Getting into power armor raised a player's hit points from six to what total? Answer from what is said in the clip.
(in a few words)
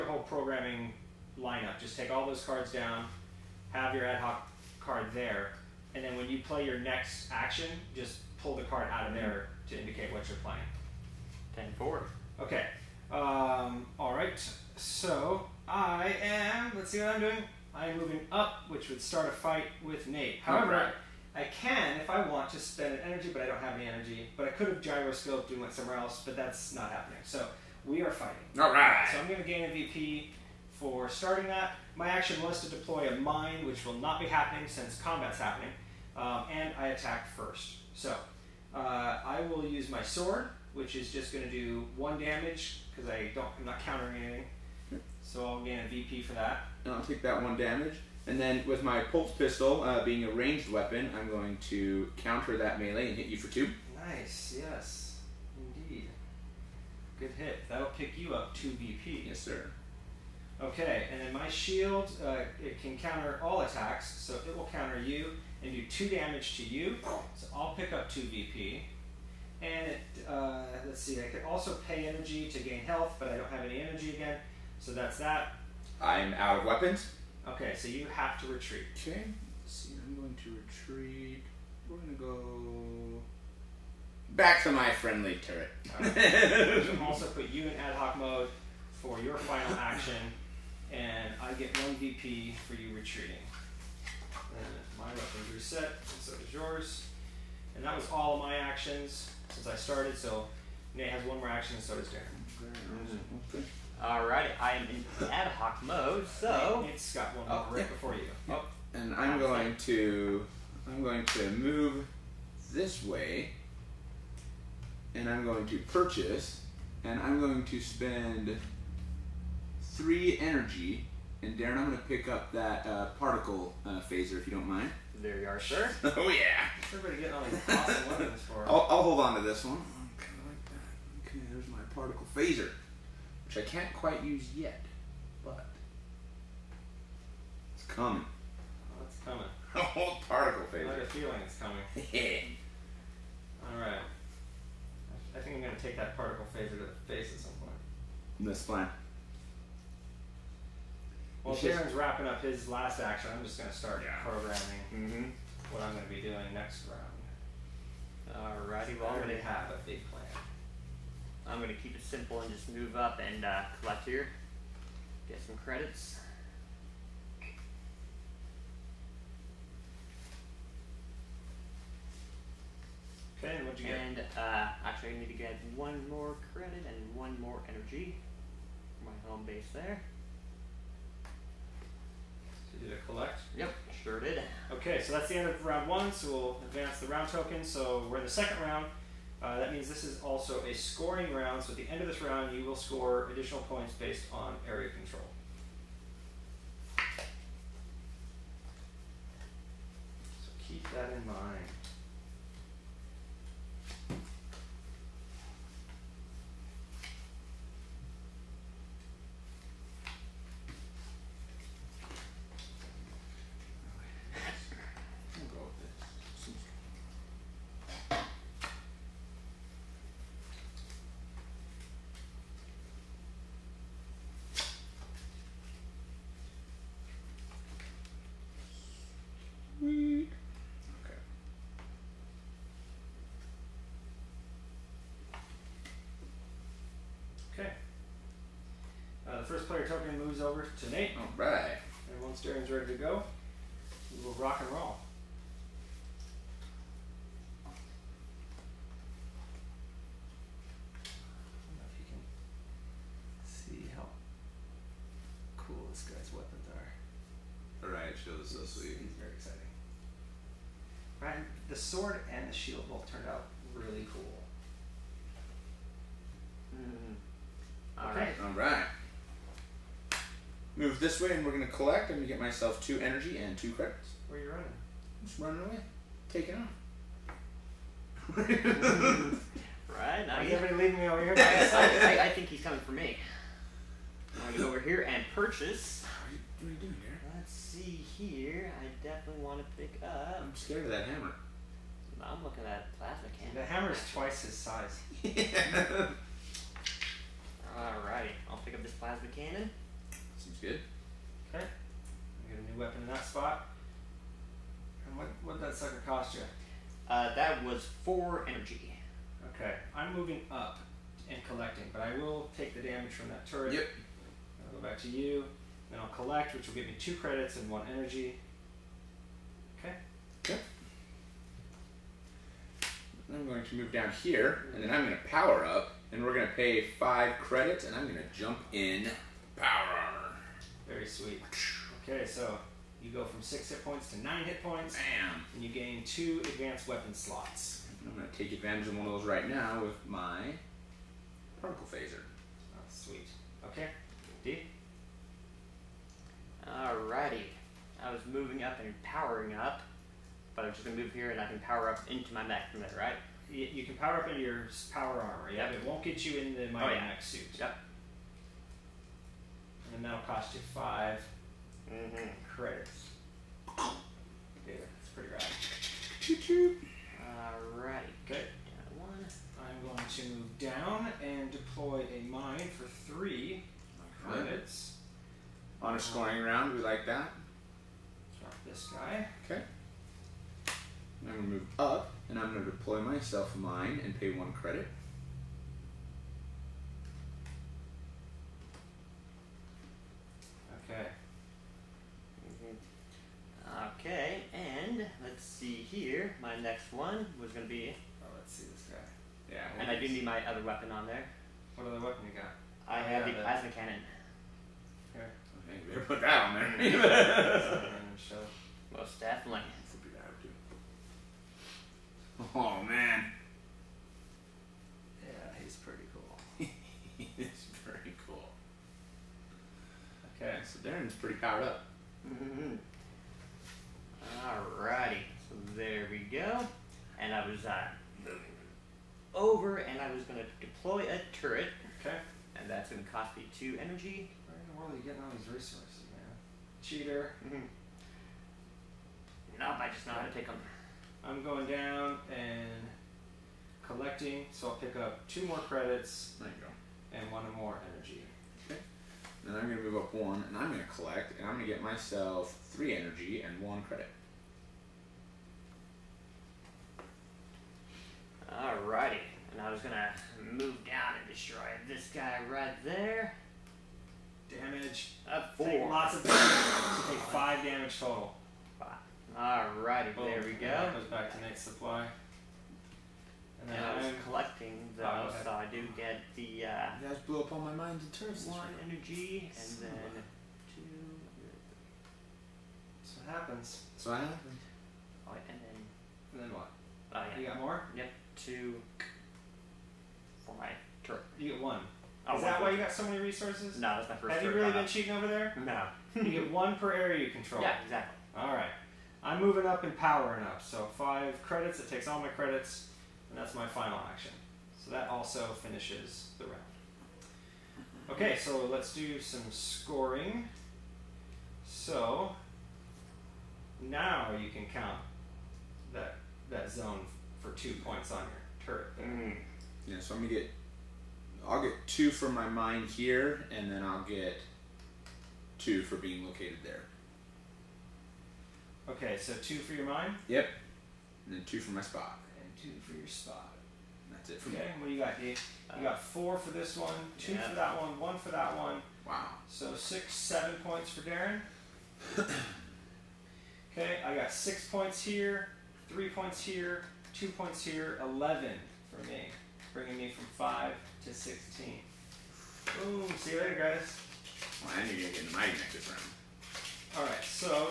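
9.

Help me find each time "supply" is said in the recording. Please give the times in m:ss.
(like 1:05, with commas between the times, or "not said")
7:51.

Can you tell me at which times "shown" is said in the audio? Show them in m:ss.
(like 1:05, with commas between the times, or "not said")
not said.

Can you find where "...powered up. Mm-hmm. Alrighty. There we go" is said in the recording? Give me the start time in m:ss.
7:01.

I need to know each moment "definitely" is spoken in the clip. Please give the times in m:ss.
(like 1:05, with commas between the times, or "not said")
4:49, 6:49.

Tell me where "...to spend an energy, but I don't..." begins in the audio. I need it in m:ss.
0:22.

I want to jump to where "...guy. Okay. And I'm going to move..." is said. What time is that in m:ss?
6:18.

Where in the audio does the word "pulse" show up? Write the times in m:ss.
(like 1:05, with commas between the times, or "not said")
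0:49.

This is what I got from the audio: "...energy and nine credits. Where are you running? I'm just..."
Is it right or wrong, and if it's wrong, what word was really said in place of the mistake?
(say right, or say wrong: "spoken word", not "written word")
wrong: "two", not "nine".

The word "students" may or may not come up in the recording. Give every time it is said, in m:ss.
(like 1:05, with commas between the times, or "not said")
not said.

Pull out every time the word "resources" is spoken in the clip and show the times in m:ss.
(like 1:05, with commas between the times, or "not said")
7:15, 8:13.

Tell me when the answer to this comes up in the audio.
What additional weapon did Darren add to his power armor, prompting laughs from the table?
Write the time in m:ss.
6:43.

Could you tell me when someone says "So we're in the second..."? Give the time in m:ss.
3:07.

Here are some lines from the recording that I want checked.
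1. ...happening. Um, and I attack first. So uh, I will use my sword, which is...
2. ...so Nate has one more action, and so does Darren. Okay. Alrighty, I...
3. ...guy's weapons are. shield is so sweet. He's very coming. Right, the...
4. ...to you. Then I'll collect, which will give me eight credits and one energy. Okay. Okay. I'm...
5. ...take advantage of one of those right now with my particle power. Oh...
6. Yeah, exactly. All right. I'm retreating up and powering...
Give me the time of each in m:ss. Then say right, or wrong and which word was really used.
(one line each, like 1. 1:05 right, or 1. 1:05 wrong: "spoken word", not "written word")
1. 0:35 right
2. 1:40 right
3. 4:16 wrong: "exciting", not "coming"
4. 5:15 wrong: "two", not "eight"
5. 5:38 wrong: "phaser", not "power"
6. 8:17 wrong: "moving", not "retreating".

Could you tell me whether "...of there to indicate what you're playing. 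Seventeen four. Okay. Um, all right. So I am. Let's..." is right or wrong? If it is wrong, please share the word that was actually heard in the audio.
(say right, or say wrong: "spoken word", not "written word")
wrong: "Ten", not "Seventeen".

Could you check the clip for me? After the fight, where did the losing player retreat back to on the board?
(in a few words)
friendly turret.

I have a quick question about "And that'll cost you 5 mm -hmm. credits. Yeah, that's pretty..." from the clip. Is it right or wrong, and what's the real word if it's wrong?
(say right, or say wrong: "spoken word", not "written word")
right.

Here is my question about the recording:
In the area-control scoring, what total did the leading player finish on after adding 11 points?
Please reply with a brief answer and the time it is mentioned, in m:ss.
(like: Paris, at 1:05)
16, at 9:10.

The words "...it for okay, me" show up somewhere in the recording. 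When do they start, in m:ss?
8:54.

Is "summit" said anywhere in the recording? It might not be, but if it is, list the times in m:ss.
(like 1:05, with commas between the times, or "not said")
not said.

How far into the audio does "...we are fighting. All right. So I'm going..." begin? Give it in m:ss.
0:27.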